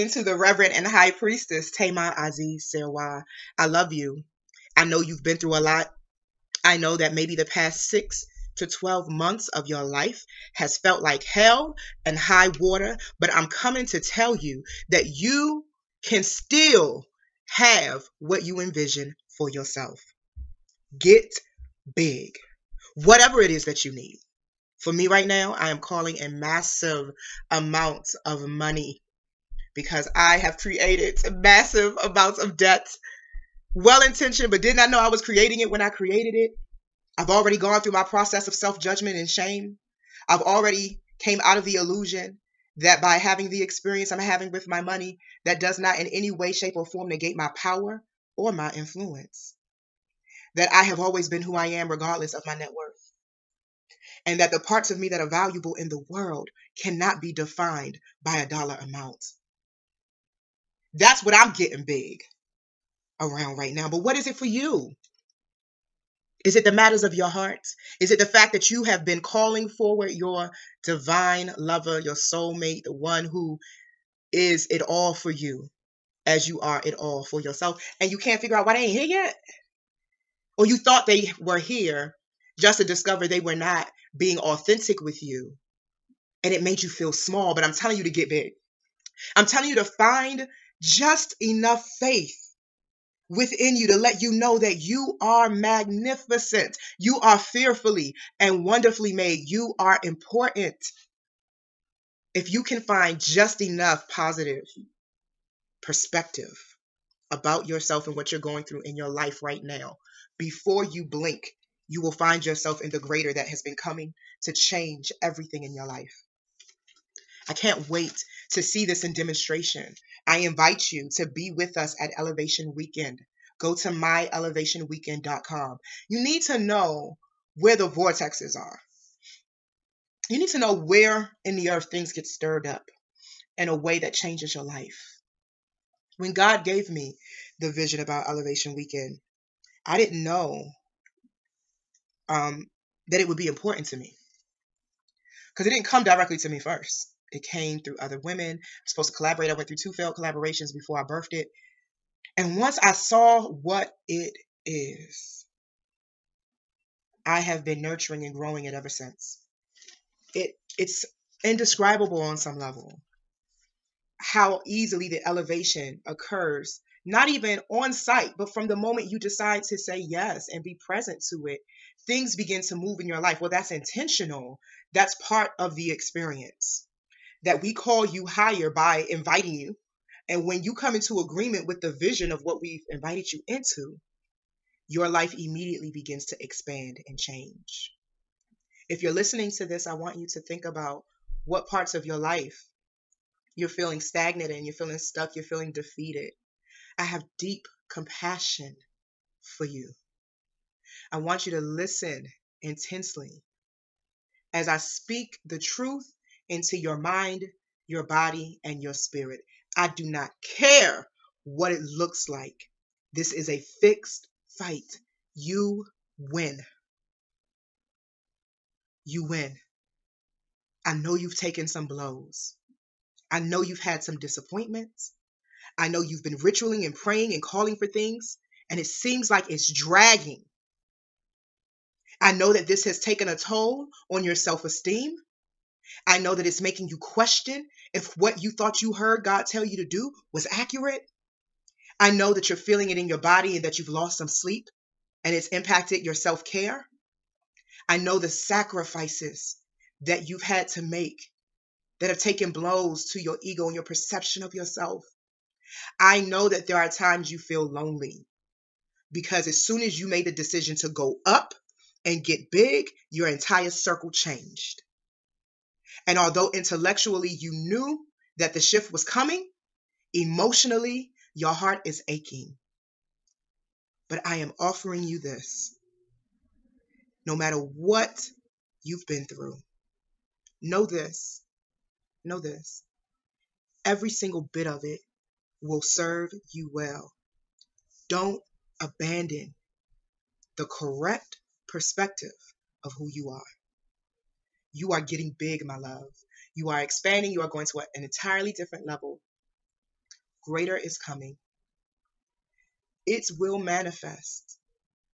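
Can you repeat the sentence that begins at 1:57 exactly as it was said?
I can't wait to see this in demonstration.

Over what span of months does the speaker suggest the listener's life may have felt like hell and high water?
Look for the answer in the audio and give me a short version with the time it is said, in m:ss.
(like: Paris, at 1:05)
6 to 12 months, at 0:07.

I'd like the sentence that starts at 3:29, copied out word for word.
I do not care what it looks like.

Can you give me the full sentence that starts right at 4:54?
You are getting big, my love.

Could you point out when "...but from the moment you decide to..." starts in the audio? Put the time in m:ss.
2:48.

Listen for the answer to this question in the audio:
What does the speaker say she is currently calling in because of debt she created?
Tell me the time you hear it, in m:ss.
0:26.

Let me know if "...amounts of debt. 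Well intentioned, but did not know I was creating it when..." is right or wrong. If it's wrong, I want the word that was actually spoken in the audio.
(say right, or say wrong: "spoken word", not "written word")
right.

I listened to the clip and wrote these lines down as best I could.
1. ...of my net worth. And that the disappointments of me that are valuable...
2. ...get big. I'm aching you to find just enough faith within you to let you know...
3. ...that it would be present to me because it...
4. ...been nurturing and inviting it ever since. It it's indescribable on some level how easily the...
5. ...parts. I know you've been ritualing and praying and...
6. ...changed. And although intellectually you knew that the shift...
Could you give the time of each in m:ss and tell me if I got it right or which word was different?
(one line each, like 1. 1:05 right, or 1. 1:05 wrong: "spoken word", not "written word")
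1. 0:52 wrong: "parts", not "disappointments"
2. 1:28 wrong: "telling", not "aching"
3. 2:23 wrong: "important", not "present"
4. 2:37 wrong: "growing", not "inviting"
5. 3:44 wrong: "disappointments", not "parts"
6. 4:24 right.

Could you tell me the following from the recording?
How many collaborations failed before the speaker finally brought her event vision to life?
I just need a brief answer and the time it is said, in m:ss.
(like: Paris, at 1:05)
2, at 2:29.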